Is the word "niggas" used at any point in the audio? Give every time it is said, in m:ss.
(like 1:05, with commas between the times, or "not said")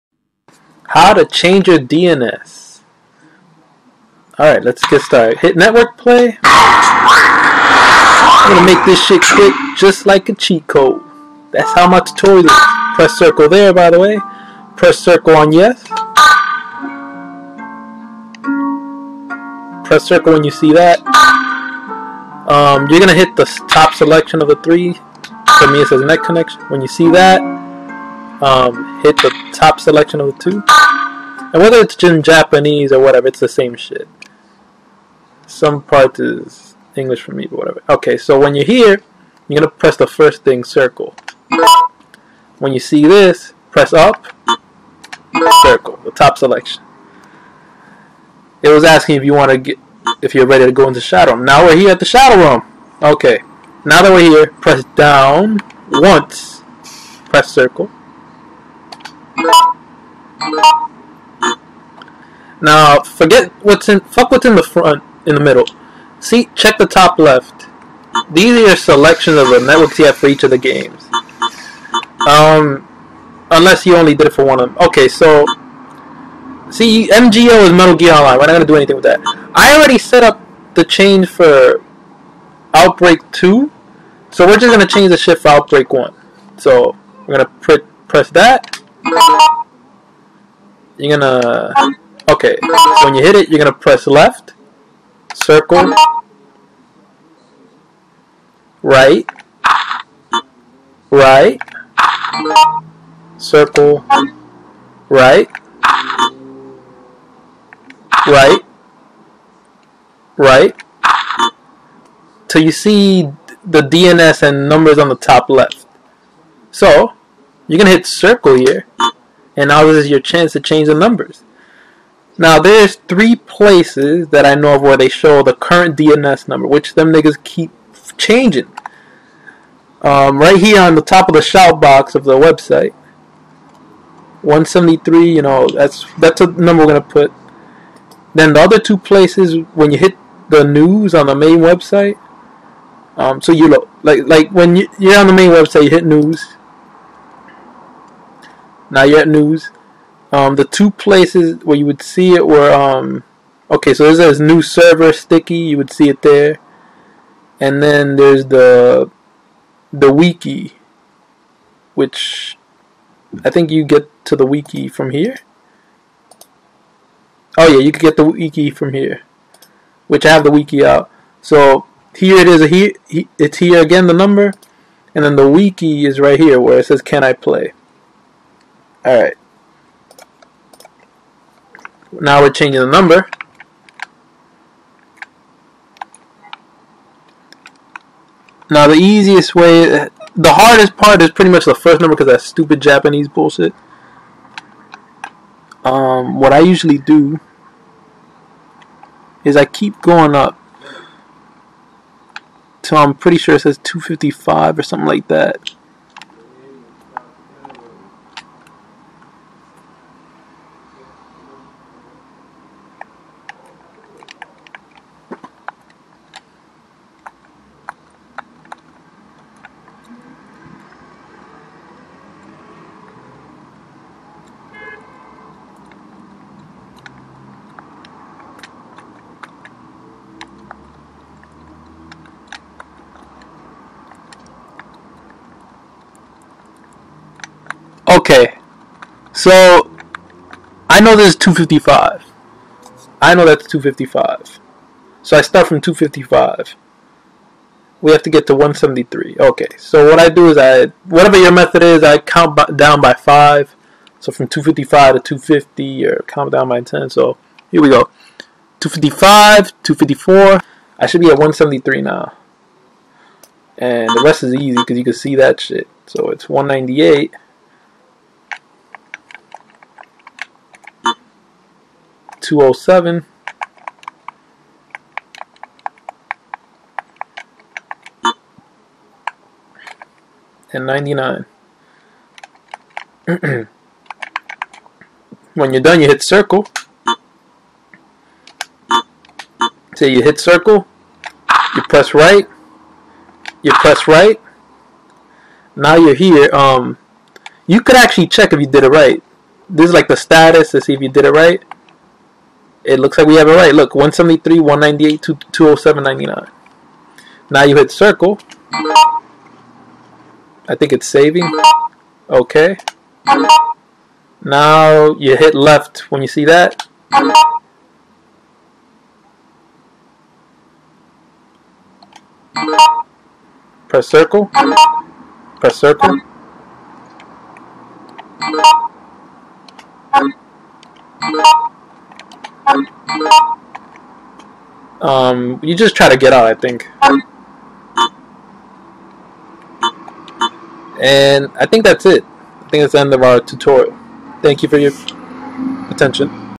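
2:07.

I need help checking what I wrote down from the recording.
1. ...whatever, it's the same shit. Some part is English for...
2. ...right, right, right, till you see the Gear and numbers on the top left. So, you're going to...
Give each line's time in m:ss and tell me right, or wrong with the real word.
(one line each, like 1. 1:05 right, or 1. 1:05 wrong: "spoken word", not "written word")
1. 0:32 right
2. 1:45 wrong: "DNS", not "Gear".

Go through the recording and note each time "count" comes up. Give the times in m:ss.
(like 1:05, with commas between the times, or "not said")
4:12, 4:16.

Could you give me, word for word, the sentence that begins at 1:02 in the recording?
Now, forget what's in, fuck what's in the front, in the middle.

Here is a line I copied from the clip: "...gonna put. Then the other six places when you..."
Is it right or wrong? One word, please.
wrong.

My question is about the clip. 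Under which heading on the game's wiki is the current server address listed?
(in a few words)
Can I play.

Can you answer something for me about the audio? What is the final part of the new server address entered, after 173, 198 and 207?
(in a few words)
99.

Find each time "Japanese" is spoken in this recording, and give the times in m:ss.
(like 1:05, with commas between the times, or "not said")
0:32, 3:12.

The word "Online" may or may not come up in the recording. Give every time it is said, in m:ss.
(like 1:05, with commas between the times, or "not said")
1:18.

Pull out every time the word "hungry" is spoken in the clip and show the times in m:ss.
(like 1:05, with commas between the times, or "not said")
not said.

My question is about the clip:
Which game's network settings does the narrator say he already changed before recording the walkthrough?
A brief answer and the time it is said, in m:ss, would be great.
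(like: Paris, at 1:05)
Outbreak Two, at 1:22.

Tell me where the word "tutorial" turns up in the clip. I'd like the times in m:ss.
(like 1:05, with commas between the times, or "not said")
0:11, 5:43.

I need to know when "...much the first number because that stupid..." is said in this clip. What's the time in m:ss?
3:11.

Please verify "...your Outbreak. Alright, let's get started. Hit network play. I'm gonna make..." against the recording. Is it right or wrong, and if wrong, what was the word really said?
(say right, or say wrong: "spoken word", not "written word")
wrong: "DNS", not "Outbreak".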